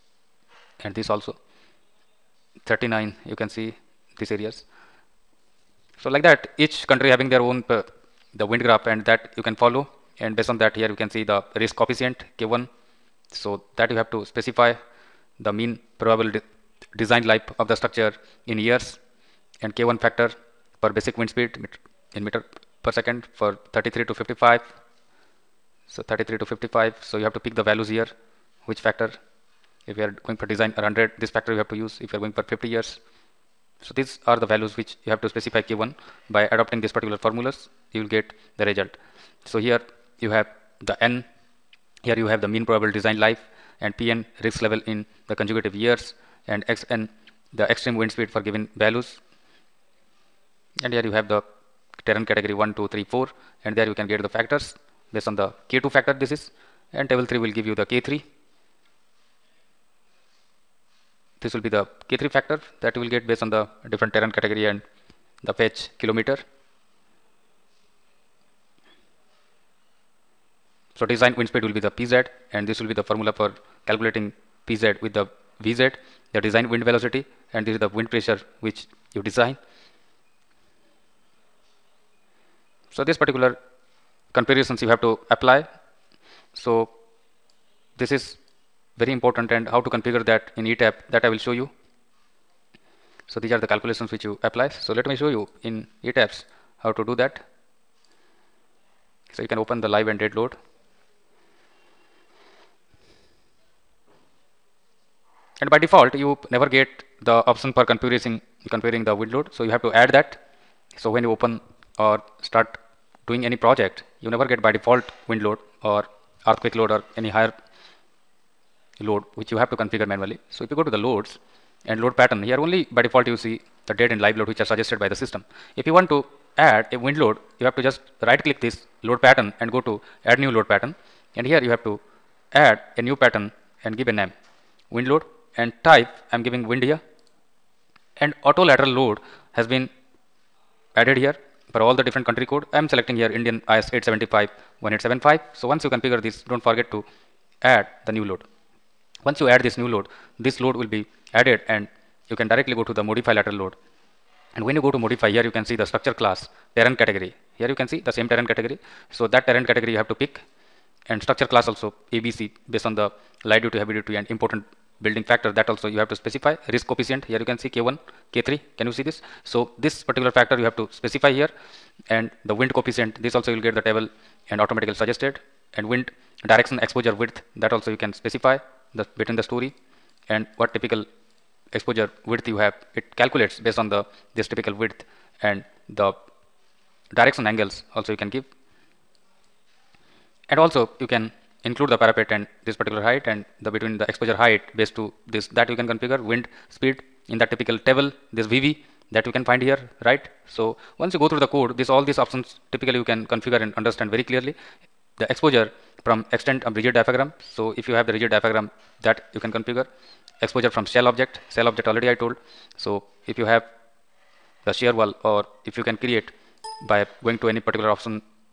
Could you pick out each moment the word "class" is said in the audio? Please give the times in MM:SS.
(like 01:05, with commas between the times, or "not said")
02:36, 02:41.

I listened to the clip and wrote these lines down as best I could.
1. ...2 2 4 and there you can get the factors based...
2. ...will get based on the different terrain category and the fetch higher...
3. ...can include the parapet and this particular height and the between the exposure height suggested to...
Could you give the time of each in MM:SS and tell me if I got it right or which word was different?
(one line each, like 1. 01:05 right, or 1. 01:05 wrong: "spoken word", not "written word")
1. 00:52 wrong: "3", not "2"
2. 01:02 wrong: "kilometer", not "higher"
3. 03:11 wrong: "based", not "suggested".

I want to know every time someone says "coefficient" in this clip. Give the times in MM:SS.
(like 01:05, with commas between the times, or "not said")
00:11, 02:46, 02:52.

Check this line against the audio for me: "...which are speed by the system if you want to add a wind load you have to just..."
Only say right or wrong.
wrong.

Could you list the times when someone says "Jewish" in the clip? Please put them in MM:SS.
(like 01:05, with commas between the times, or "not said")
not said.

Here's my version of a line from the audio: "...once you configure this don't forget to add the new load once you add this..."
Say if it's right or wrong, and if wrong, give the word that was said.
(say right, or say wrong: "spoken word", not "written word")
right.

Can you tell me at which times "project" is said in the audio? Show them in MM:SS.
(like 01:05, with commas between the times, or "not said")
01:53.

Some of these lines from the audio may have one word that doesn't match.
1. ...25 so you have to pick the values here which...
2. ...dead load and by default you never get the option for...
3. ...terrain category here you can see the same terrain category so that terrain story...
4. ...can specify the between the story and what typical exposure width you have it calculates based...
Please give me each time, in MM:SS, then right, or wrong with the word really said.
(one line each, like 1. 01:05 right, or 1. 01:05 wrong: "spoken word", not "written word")
1. 00:26 wrong: "55", not "25"
2. 01:40 right
3. 02:36 wrong: "category", not "story"
4. 02:58 right.